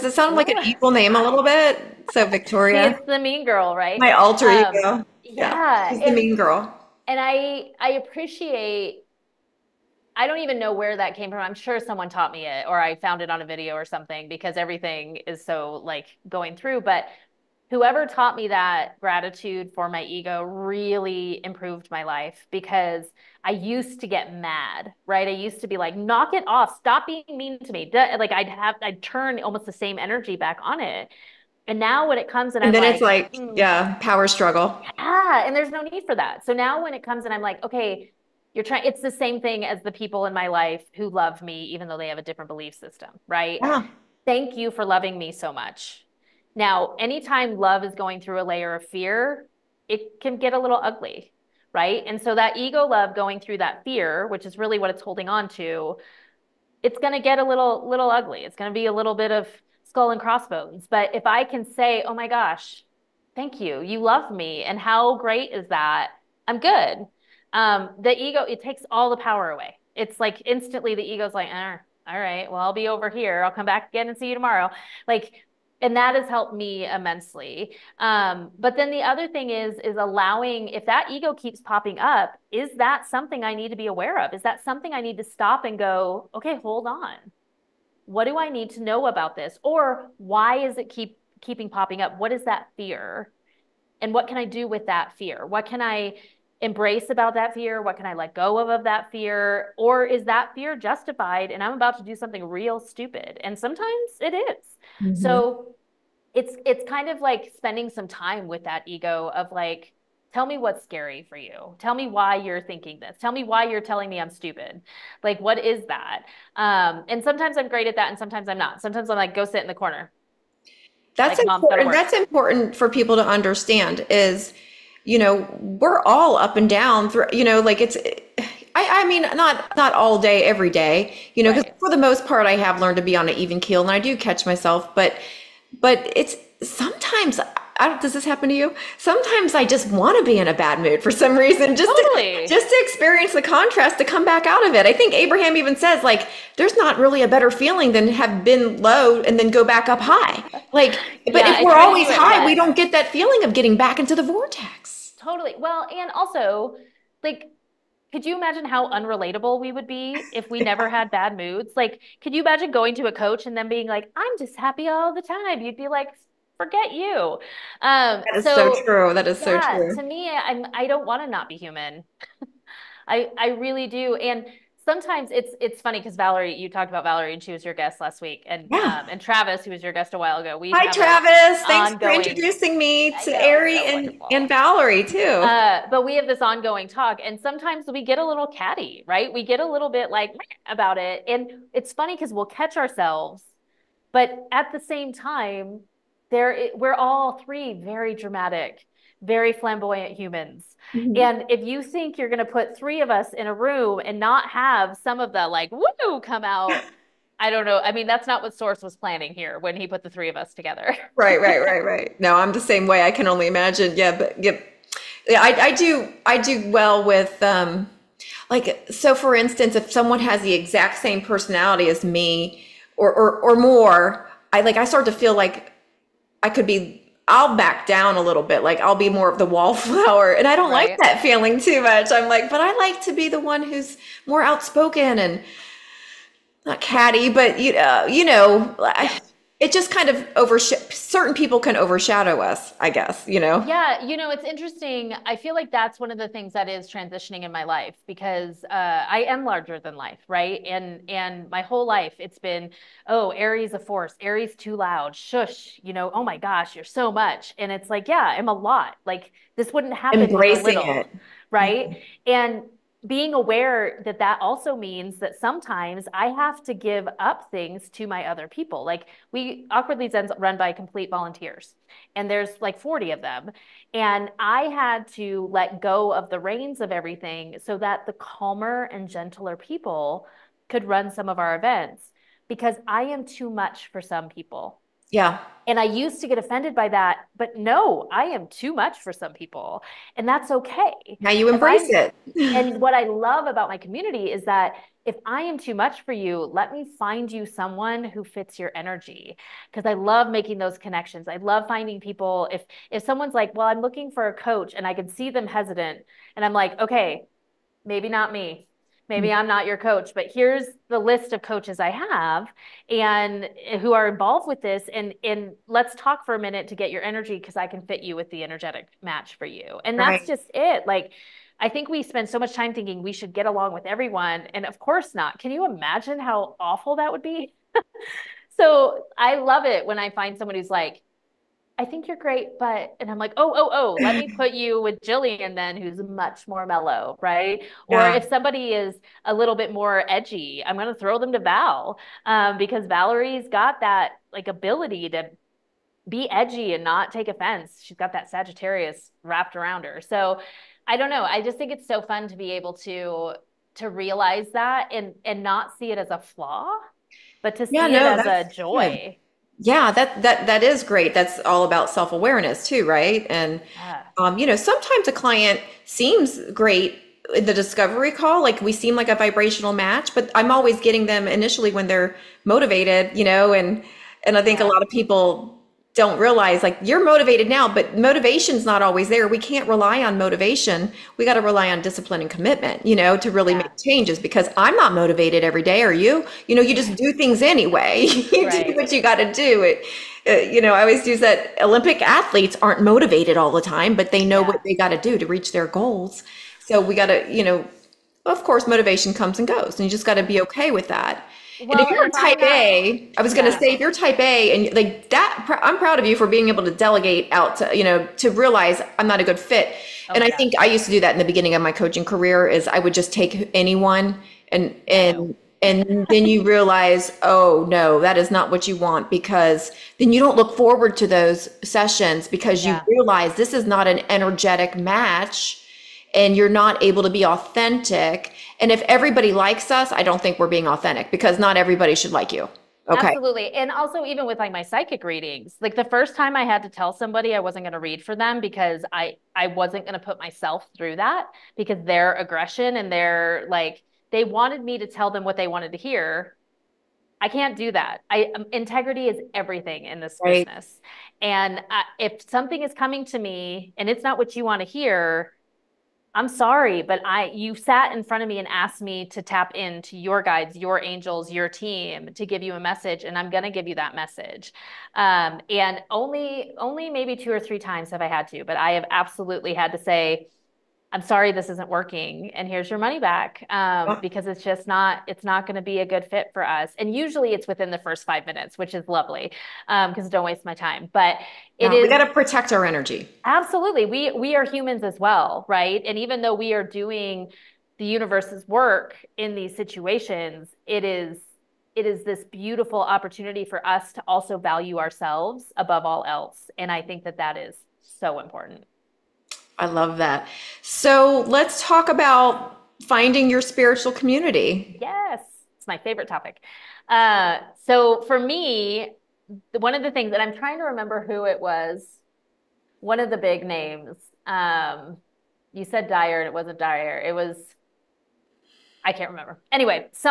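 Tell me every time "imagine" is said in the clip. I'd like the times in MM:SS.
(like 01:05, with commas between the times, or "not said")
02:38, 02:42, 03:33, 05:25.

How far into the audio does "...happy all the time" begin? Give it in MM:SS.
02:44.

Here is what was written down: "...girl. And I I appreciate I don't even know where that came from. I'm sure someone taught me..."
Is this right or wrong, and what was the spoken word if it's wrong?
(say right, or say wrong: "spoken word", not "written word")
right.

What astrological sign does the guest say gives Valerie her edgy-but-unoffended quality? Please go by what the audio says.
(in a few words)
Sagittarius.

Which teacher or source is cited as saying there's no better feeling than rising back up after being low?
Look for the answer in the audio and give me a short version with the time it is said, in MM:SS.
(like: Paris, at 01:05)
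Abraham, at 02:25.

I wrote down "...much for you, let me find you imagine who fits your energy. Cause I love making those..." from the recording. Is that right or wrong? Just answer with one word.
wrong.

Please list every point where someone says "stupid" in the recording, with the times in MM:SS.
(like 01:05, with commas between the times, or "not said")
01:42, 01:54.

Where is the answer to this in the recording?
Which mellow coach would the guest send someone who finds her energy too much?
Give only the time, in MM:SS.
05:35.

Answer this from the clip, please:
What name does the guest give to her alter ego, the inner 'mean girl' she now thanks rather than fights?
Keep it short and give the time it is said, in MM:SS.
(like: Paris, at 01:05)
Victoria, at 00:02.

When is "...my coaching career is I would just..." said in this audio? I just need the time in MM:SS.
06:51.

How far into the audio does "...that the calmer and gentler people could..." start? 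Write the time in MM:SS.
04:37.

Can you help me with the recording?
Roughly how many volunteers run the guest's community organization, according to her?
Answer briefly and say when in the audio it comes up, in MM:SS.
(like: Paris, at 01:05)
40, at 04:32.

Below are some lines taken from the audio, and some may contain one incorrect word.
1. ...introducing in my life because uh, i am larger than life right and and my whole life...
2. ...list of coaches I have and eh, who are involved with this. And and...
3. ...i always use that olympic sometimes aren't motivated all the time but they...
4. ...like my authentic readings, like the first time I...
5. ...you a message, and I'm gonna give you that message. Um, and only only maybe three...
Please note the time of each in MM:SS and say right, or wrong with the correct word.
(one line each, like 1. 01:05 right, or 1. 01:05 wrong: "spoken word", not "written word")
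1. 04:06 wrong: "transitioning", not "introducing"
2. 05:10 right
3. 06:30 wrong: "athletes", not "sometimes"
4. 07:14 wrong: "psychic", not "authentic"
5. 07:42 wrong: "two", not "three".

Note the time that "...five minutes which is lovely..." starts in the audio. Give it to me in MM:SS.
07:58.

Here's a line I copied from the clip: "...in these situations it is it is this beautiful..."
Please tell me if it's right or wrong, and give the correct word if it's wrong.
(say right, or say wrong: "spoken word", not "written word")
right.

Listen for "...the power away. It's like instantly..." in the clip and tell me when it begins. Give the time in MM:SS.
01:09.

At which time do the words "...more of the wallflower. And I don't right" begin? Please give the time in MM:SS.
03:49.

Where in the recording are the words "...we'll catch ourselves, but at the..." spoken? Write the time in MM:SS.
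03:12.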